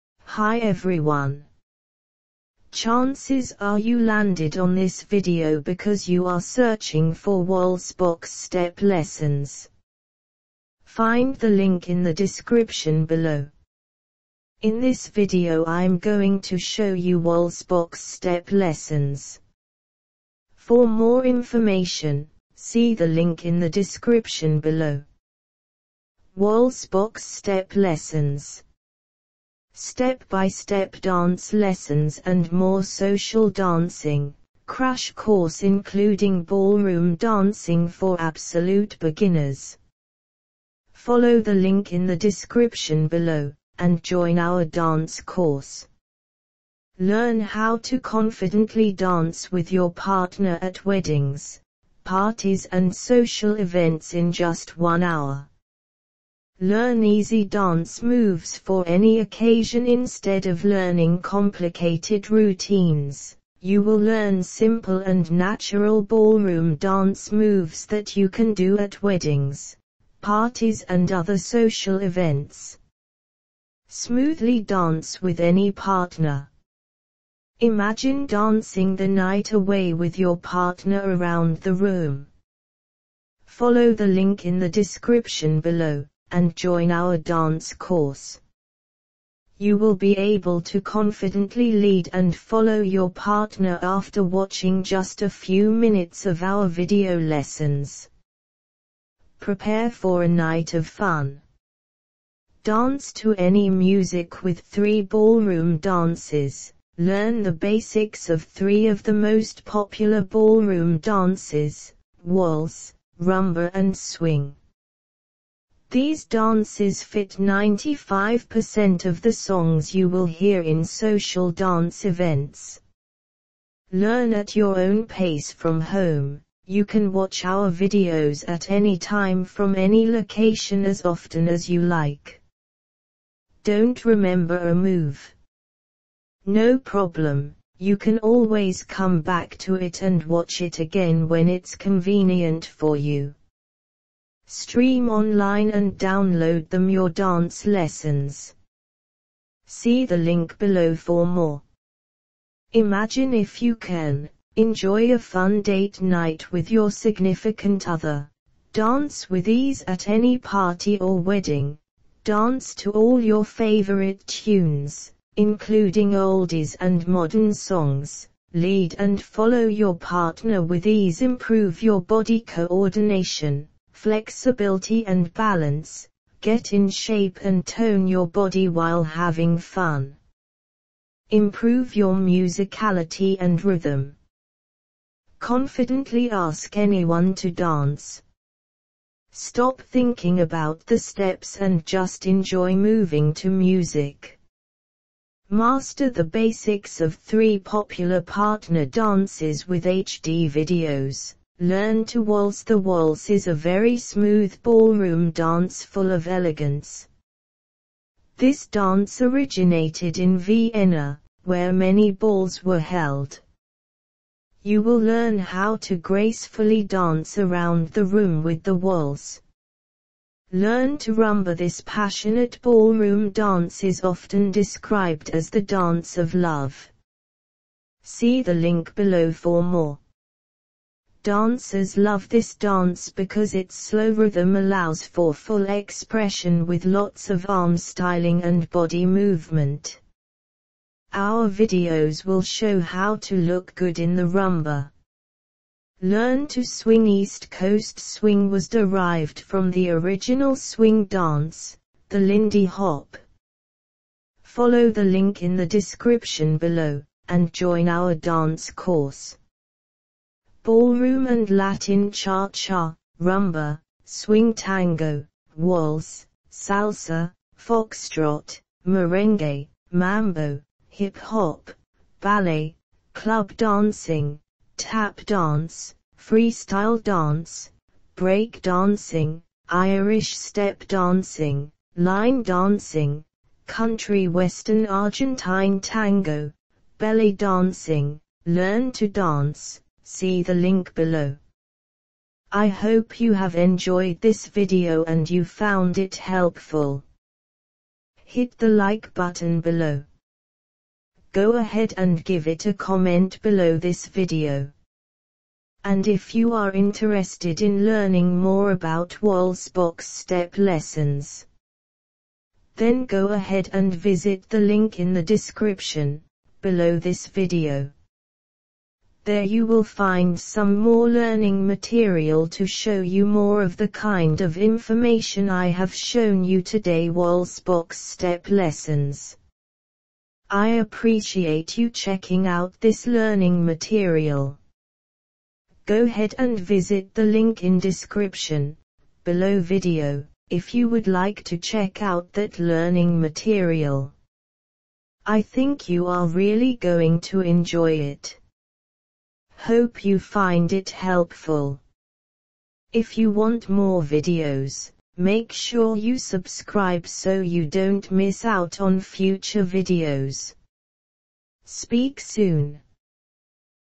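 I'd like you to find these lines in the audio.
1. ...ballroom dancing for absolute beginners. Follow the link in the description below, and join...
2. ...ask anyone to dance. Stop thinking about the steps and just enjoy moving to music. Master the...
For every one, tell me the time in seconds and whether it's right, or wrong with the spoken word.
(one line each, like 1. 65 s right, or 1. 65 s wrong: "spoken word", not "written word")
1. 36 s right
2. 186 s right.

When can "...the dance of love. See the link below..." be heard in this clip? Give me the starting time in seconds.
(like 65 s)
225 s.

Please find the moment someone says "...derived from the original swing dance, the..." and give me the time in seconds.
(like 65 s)
248 s.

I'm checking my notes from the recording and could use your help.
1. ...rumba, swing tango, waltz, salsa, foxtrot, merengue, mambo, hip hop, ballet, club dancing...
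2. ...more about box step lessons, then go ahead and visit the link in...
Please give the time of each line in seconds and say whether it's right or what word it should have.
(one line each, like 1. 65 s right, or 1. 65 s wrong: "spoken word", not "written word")
1. 263 s right
2. 308 s right.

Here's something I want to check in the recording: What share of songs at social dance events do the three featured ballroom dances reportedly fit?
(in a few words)
95%.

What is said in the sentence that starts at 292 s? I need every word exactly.
I hope you have enjoyed this video and you found it helpful.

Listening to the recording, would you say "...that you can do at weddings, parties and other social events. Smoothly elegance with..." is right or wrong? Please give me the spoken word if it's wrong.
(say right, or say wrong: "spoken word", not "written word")
wrong: "dance", not "elegance".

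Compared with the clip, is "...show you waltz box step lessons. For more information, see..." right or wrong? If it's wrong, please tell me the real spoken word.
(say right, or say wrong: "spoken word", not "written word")
right.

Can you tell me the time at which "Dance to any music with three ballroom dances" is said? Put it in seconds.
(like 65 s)
102 s.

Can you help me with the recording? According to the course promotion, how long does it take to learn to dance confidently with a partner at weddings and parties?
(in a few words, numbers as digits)
1 hour.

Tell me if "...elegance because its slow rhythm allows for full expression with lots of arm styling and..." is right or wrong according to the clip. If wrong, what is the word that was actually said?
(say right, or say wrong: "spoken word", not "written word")
wrong: "dance", not "elegance".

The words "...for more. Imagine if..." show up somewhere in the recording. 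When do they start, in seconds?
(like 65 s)
150 s.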